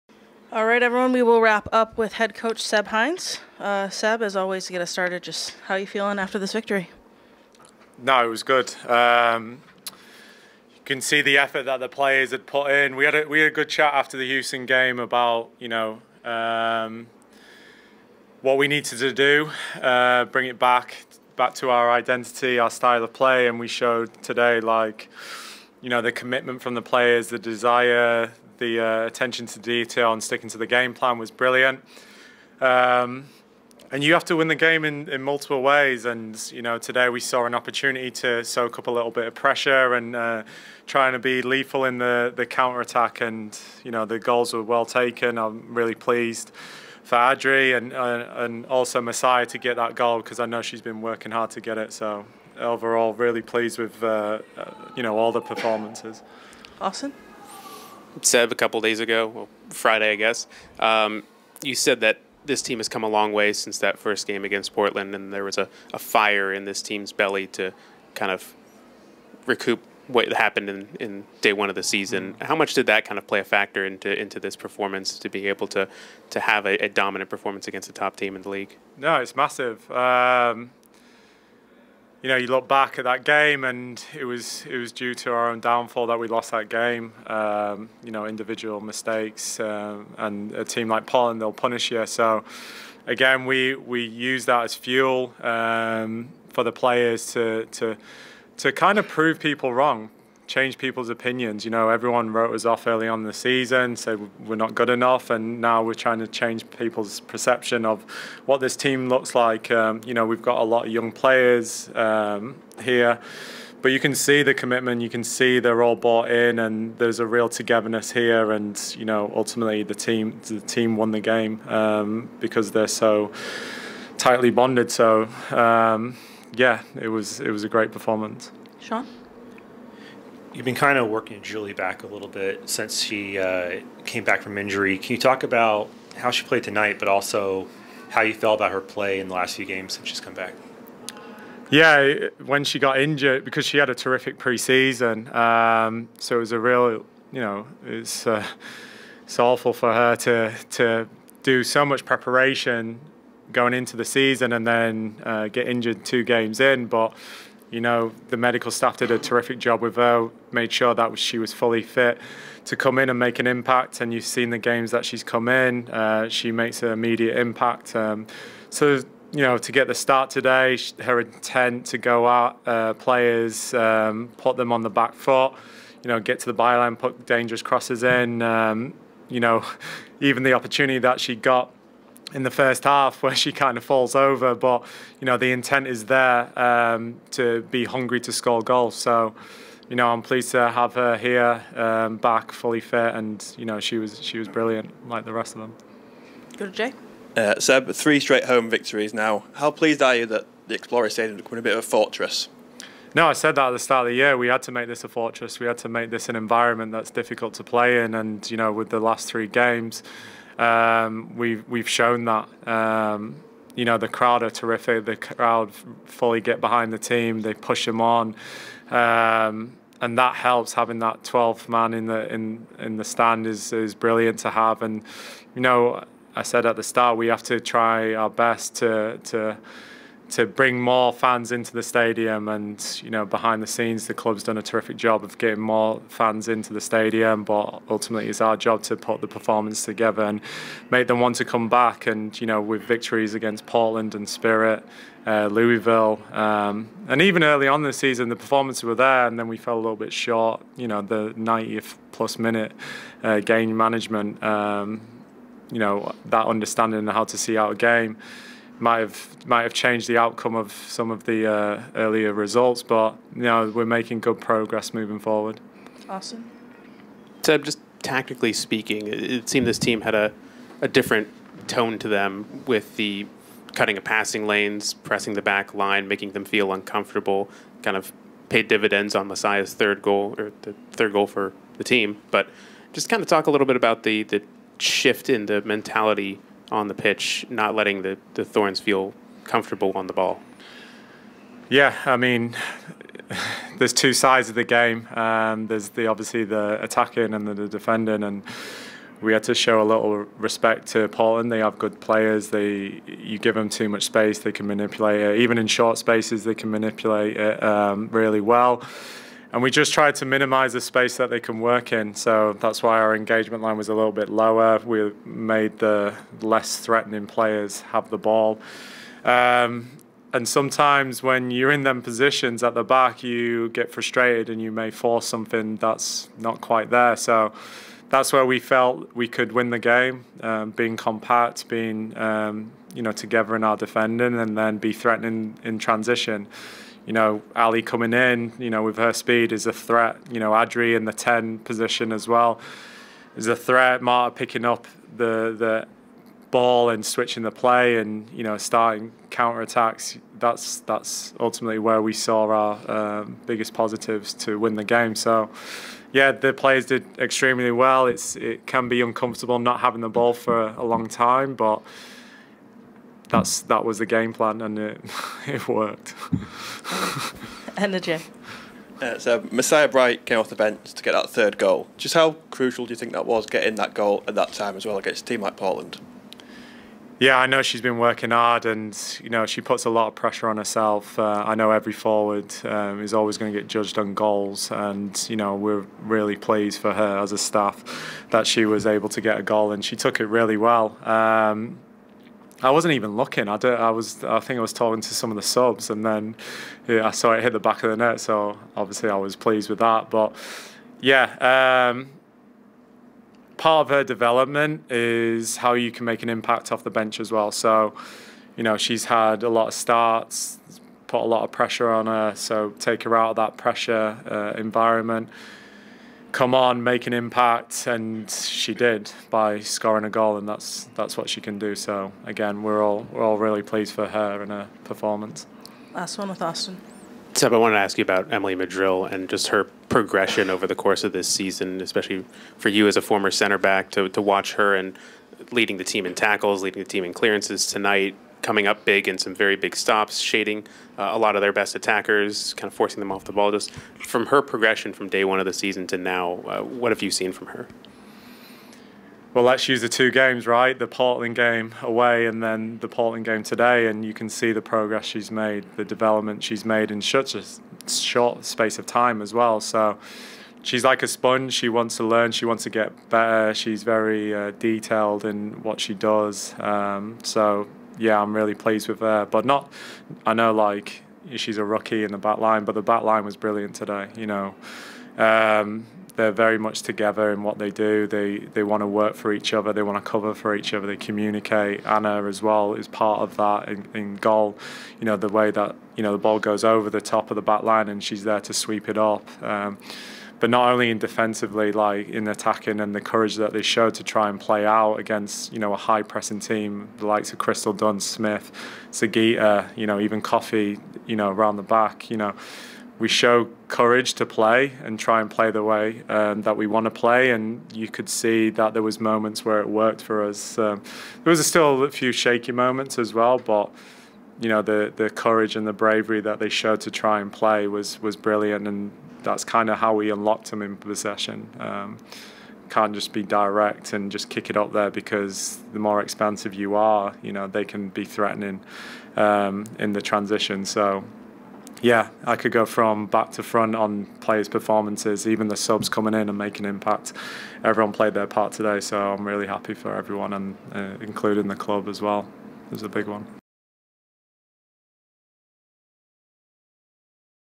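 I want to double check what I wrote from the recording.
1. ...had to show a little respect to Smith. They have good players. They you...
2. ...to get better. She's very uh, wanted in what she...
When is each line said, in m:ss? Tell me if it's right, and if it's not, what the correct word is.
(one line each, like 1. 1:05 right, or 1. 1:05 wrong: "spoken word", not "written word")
1. 4:59 wrong: "Portland", not "Smith"
2. 7:42 wrong: "detailed", not "wanted".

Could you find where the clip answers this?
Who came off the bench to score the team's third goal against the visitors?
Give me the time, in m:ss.
6:09.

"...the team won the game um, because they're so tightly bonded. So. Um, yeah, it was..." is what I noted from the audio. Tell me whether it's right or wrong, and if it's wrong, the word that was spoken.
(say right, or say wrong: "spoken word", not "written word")
right.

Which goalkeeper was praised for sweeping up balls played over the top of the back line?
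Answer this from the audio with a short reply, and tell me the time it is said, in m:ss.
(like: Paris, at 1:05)
Anna, at 8:01.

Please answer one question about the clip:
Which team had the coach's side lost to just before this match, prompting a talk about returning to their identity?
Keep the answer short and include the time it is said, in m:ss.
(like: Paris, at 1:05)
Houston, at 0:14.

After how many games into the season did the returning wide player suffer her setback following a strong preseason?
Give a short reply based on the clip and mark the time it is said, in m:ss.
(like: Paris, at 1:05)
2, at 2:36.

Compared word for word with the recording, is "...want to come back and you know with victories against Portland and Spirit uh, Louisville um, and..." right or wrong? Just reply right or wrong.
right.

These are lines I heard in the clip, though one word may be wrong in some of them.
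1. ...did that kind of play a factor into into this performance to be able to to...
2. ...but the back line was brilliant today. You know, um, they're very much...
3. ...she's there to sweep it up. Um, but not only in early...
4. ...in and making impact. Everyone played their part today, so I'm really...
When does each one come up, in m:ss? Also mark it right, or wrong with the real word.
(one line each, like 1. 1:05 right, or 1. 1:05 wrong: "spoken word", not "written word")
1. 1:12 right
2. 7:52 right
3. 8:08 wrong: "defensively", not "early"
4. 8:56 right.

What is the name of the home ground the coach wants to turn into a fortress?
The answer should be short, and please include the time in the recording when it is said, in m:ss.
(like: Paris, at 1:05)
Exploria Stadium, at 3:20.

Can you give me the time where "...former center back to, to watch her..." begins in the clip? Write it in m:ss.
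7:13.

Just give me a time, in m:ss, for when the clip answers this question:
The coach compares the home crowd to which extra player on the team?
3:41.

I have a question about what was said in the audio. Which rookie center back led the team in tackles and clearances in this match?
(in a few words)
Emily Madril.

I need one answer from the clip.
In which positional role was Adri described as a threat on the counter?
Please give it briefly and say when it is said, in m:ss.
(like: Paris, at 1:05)
the 10 position, at 5:41.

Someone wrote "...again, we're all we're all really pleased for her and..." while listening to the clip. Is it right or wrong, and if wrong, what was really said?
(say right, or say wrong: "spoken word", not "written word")
right.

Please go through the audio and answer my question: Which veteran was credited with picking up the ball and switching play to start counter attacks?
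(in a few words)
Marta.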